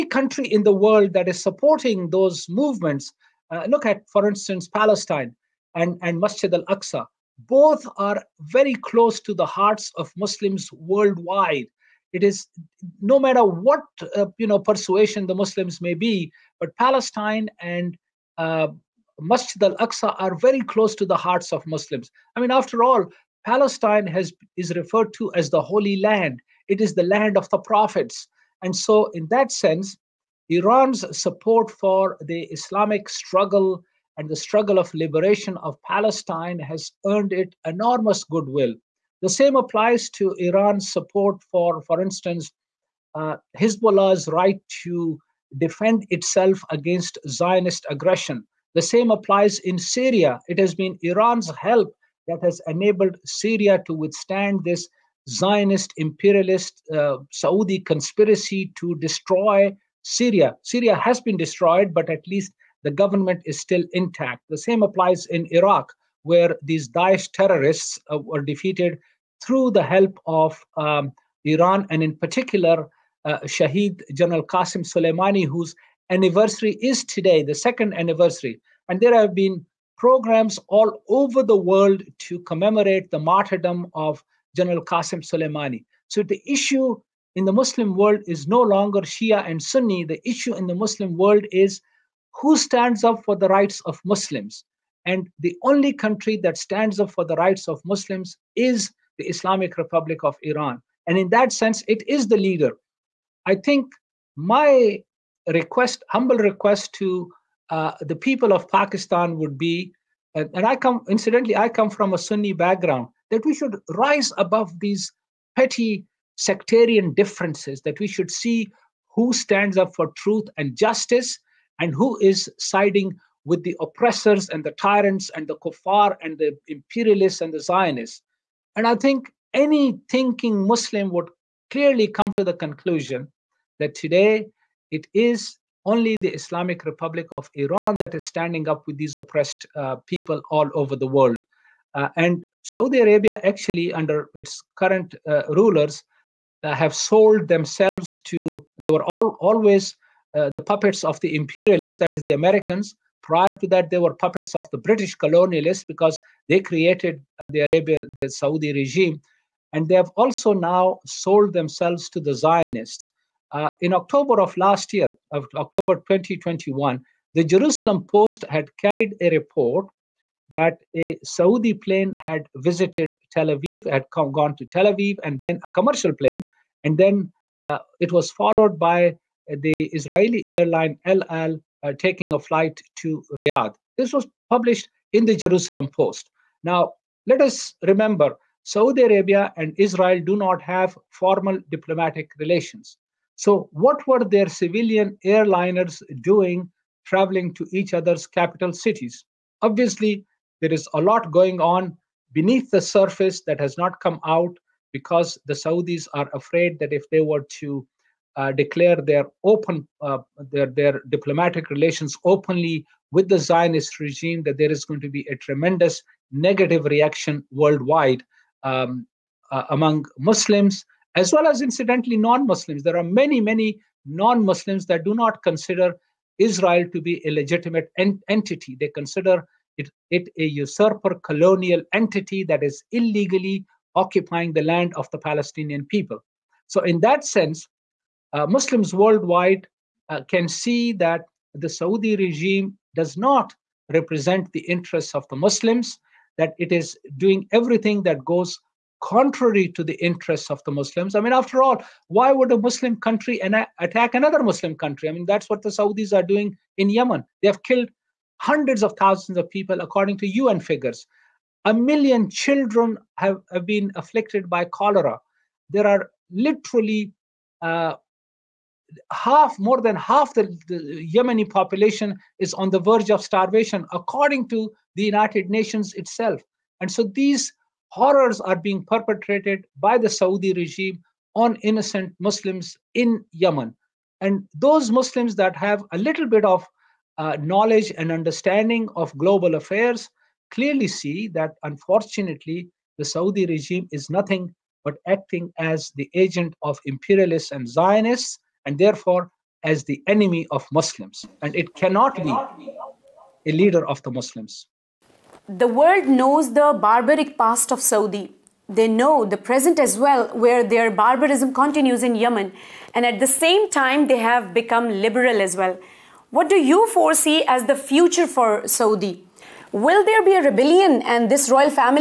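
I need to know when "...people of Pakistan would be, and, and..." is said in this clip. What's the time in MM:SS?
01:48.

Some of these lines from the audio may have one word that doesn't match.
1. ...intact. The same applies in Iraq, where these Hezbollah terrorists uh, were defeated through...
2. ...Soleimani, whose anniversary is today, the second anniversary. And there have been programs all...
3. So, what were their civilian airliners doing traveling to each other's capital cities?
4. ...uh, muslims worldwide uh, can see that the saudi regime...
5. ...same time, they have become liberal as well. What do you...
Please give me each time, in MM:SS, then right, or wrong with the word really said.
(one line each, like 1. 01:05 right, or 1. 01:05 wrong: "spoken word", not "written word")
1. 01:03 wrong: "Daesh", not "Hezbollah"
2. 01:14 right
3. 03:13 right
4. 03:58 right
5. 05:13 right.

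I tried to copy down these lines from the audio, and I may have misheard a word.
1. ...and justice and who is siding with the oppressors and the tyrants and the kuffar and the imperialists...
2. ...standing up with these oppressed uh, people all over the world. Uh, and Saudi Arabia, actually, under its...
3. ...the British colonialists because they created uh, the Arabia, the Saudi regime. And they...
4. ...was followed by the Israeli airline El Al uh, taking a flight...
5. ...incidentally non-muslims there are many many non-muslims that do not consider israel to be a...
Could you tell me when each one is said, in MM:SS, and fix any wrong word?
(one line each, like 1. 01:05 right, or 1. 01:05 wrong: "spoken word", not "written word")
1. 02:00 right
2. 02:18 right
3. 02:34 right
4. 02:58 right
5. 03:41 right.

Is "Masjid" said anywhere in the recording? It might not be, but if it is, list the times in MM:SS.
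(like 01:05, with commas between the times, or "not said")
00:06, 00:19.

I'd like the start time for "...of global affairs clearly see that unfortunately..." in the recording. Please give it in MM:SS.
04:48.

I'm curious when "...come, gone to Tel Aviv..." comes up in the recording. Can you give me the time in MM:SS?
02:54.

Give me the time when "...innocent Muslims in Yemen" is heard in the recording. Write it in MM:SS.
04:41.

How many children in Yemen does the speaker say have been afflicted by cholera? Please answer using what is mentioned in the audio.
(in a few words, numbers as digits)
1,000,000.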